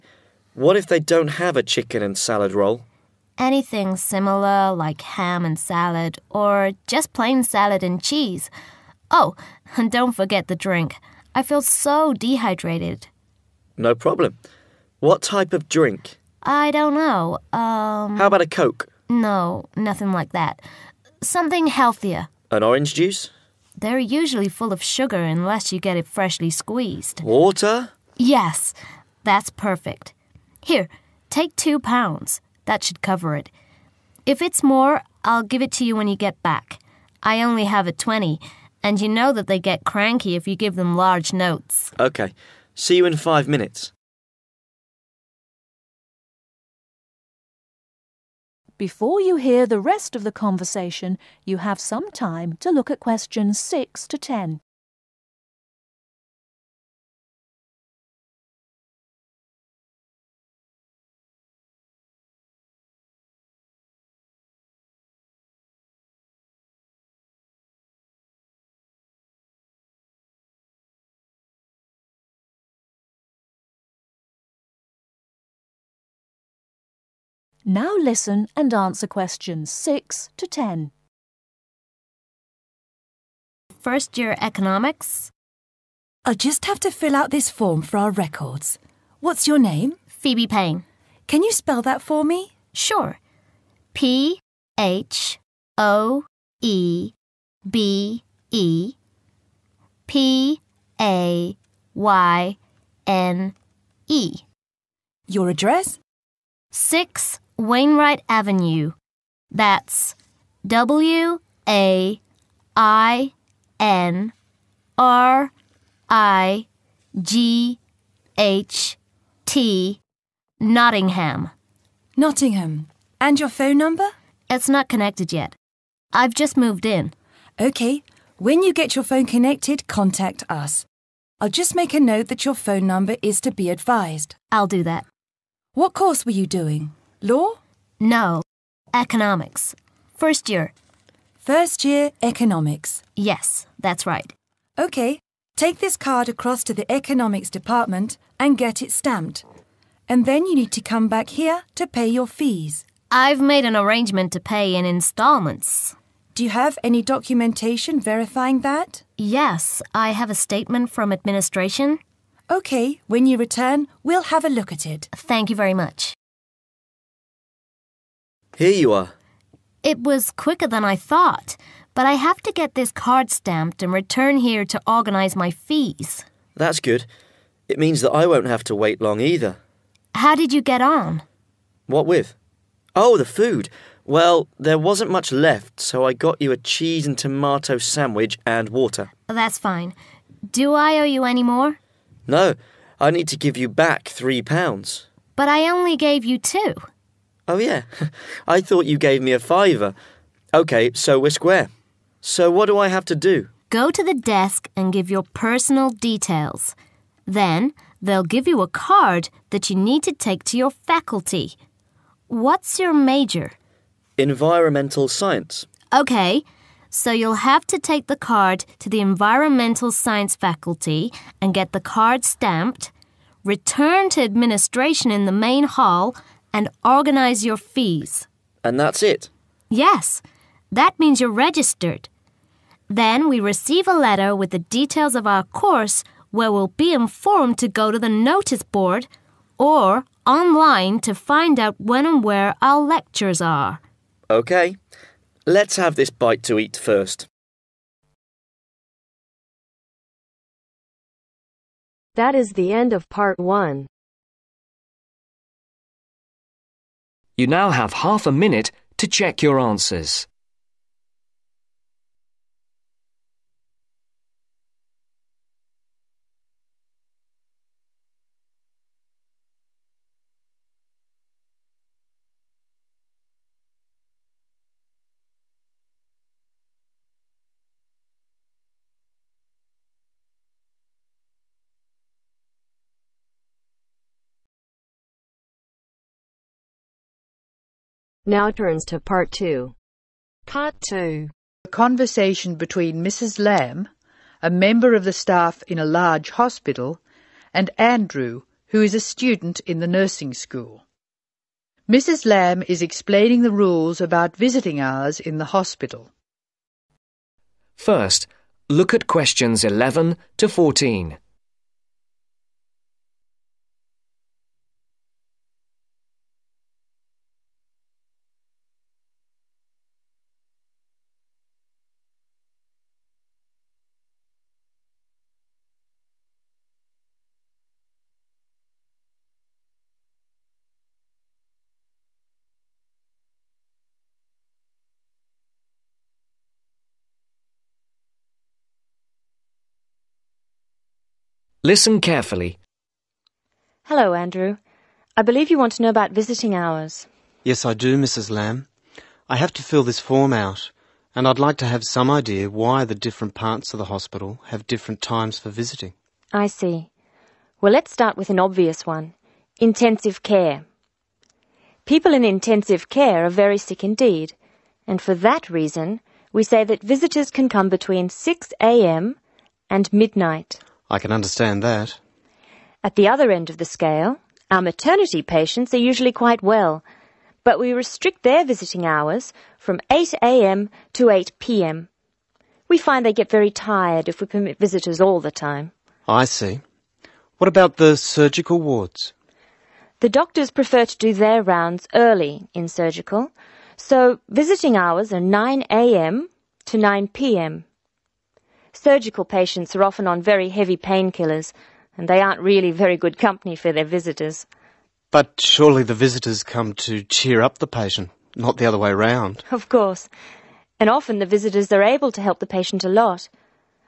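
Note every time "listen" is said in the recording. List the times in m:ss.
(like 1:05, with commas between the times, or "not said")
1:17, 5:41.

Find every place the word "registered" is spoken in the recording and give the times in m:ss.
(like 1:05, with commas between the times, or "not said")
3:51.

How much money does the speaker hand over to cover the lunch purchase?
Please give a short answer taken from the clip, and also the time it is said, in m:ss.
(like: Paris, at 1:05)
2 pounds, at 0:31.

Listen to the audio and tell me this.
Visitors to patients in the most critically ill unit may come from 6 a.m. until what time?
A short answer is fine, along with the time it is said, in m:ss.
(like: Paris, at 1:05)
Midnight, at 6:09.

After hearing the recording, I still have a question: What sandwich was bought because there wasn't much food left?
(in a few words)
Cheese and tomato.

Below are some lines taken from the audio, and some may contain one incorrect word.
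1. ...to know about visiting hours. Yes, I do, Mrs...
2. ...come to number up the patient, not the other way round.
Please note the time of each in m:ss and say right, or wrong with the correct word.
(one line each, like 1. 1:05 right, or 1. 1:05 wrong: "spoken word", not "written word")
1. 5:45 right
2. 6:46 wrong: "cheer", not "number".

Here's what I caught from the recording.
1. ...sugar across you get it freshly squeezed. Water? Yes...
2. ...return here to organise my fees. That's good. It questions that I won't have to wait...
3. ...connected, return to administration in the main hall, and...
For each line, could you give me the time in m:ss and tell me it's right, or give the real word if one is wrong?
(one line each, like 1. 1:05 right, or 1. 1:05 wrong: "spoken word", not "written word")
1. 0:24 wrong: "unless", not "across"
2. 2:53 wrong: "means", not "questions"
3. 3:42 wrong: "stamped", not "connected".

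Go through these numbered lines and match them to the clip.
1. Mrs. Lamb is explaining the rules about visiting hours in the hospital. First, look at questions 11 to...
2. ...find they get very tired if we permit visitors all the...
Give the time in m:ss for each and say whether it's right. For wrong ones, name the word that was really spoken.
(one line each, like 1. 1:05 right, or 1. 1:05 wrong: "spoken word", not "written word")
1. 5:01 right
2. 6:22 right.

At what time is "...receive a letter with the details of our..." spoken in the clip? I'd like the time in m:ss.
3:53.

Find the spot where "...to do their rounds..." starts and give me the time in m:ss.
6:30.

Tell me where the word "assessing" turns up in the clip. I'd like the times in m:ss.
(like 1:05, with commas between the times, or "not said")
not said.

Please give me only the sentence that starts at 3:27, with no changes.
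Then they'll give you a card that you need to take to your faculty.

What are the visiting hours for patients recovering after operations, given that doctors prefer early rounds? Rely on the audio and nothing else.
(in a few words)
9am to 9pm.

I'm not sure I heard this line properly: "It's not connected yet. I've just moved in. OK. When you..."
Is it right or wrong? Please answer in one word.
right.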